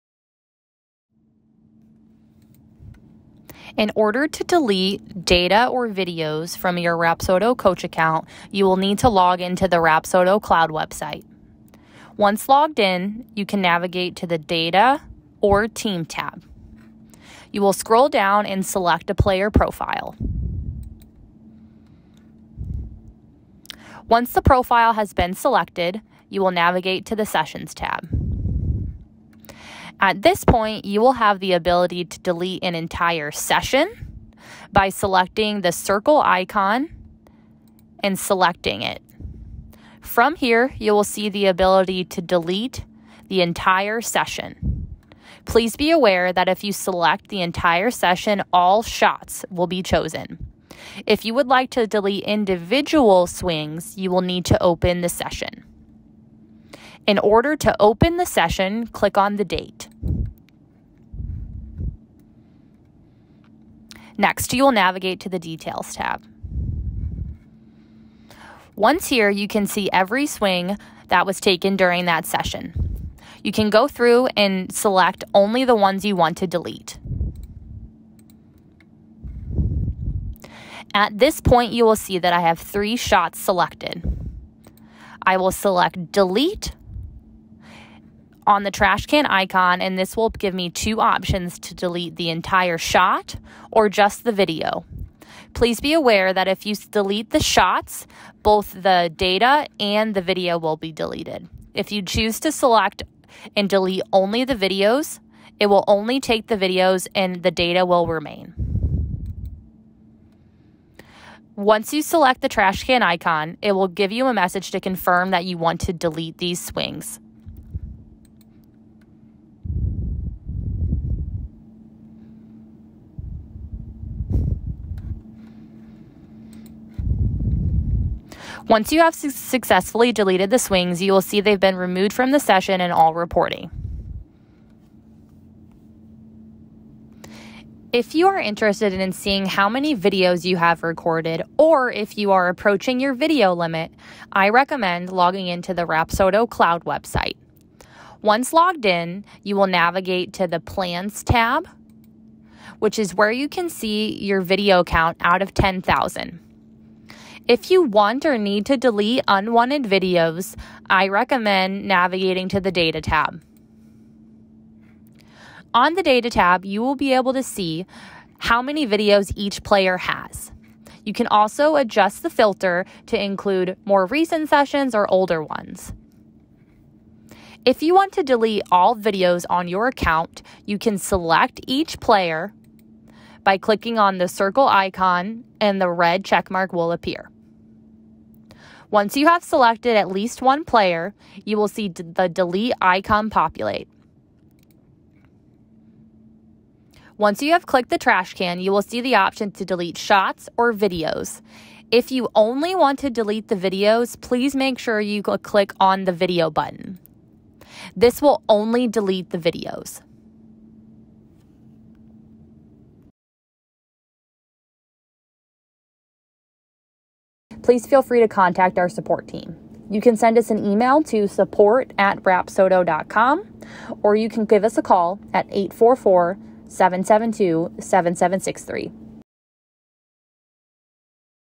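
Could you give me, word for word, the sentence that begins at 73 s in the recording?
You can go through and select only the ones you want to delete.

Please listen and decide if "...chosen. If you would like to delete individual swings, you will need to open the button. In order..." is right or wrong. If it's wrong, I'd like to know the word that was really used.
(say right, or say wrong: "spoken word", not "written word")
wrong: "session", not "button".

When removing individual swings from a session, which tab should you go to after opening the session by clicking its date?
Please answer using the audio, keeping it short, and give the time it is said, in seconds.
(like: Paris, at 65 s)
Details, at 65 s.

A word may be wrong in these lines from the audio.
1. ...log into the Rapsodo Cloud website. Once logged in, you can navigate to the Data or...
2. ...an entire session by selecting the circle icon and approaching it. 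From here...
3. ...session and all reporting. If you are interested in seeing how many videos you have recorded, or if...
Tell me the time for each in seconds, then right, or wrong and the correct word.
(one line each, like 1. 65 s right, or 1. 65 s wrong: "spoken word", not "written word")
1. 9 s right
2. 32 s wrong: "selecting", not "approaching"
3. 132 s right.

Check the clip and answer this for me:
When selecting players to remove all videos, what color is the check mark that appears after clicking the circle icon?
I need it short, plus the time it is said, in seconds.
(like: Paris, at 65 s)
Red, at 185 s.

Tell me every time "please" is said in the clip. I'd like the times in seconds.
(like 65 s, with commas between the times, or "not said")
45 s, 95 s, 204 s, 217 s.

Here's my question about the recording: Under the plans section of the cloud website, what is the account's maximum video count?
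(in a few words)
10,000.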